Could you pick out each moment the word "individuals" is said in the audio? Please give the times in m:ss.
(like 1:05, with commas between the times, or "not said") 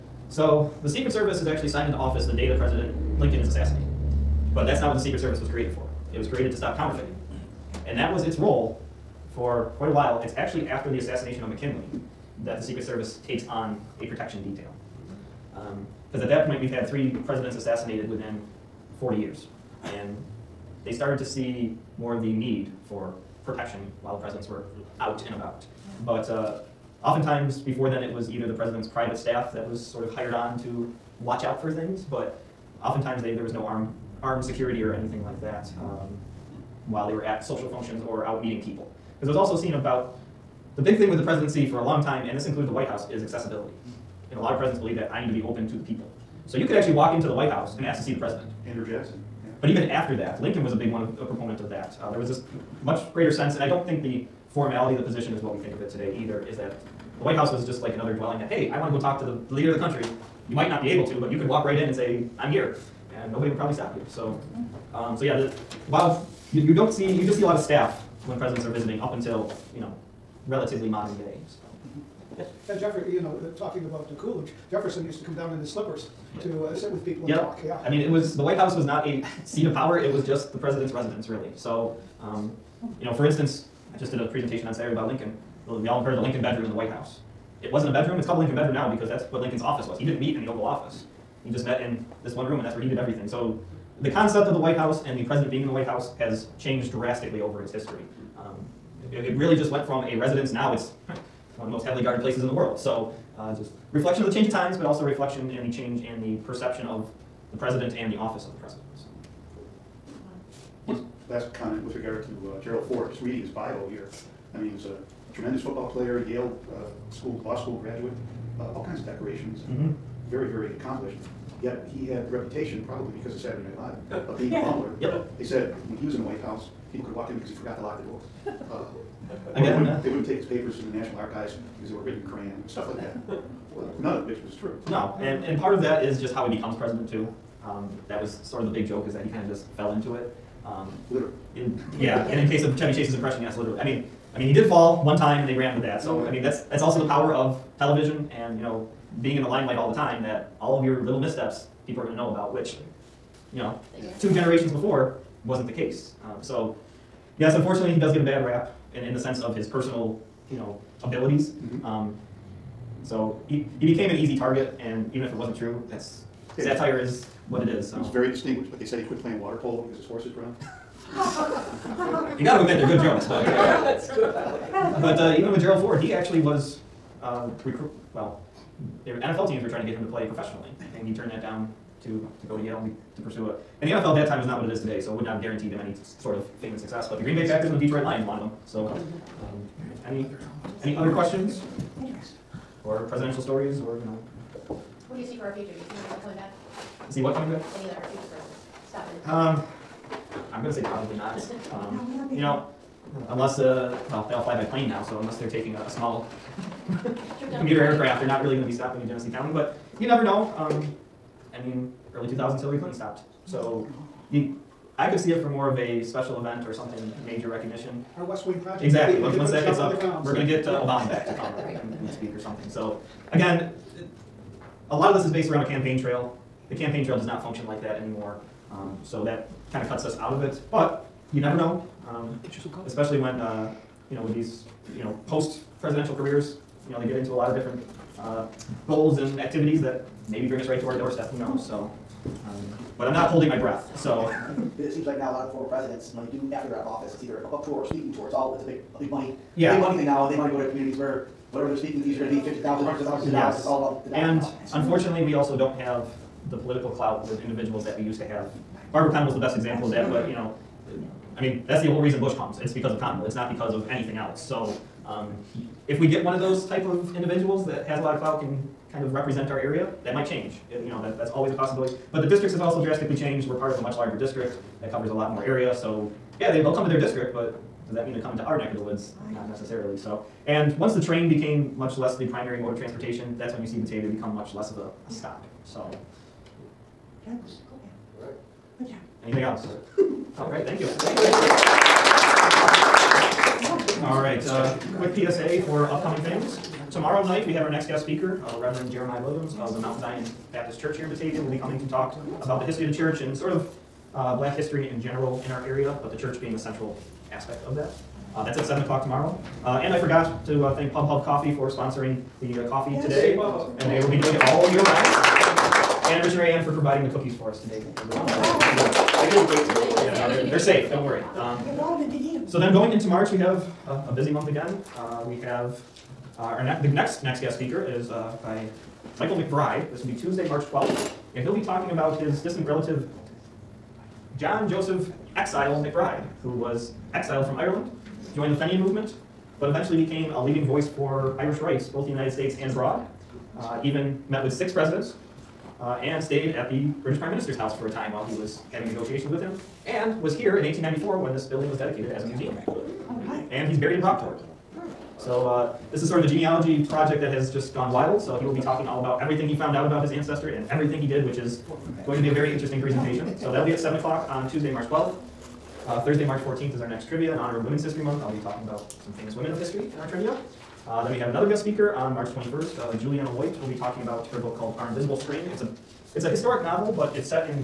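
4:17, 4:27.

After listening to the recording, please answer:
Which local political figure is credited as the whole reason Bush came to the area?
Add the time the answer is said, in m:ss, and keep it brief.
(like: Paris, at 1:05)
Barber Conable, at 4:18.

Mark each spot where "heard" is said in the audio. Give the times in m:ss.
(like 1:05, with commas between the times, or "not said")
1:26.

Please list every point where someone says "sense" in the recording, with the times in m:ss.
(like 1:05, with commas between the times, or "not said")
0:53, 2:39.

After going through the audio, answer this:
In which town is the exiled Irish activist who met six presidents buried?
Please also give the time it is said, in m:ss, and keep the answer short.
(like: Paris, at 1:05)
Brockport, at 5:54.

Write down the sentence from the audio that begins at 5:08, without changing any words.
Uh, that's at 7 o'clock tomorrow.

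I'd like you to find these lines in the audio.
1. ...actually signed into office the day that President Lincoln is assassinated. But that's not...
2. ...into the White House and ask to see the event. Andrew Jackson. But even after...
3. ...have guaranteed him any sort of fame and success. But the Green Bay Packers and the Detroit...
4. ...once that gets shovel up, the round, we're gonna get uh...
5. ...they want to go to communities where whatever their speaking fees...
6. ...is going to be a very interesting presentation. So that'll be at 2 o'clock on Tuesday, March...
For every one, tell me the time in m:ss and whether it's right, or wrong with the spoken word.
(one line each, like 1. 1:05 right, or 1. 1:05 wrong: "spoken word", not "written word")
1. 0:01 right
2. 0:47 wrong: "president", not "event"
3. 3:05 right
4. 3:39 wrong: "ground", not "round"
5. 4:10 right
6. 6:01 wrong: "7", not "2".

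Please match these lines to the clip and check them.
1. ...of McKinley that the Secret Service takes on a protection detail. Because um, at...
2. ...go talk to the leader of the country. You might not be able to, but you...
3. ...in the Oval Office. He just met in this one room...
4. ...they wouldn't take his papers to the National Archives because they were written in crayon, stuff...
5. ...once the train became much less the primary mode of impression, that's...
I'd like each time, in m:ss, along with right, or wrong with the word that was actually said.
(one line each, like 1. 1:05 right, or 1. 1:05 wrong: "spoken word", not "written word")
1. 0:11 right
2. 0:58 right
3. 1:30 right
4. 2:10 right
5. 4:40 wrong: "transportation", not "impression".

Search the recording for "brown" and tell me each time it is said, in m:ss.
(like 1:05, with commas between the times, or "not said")
2:50.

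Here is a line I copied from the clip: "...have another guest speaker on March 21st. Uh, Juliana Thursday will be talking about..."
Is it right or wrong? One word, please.
wrong.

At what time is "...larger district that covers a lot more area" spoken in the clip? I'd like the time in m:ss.
4:33.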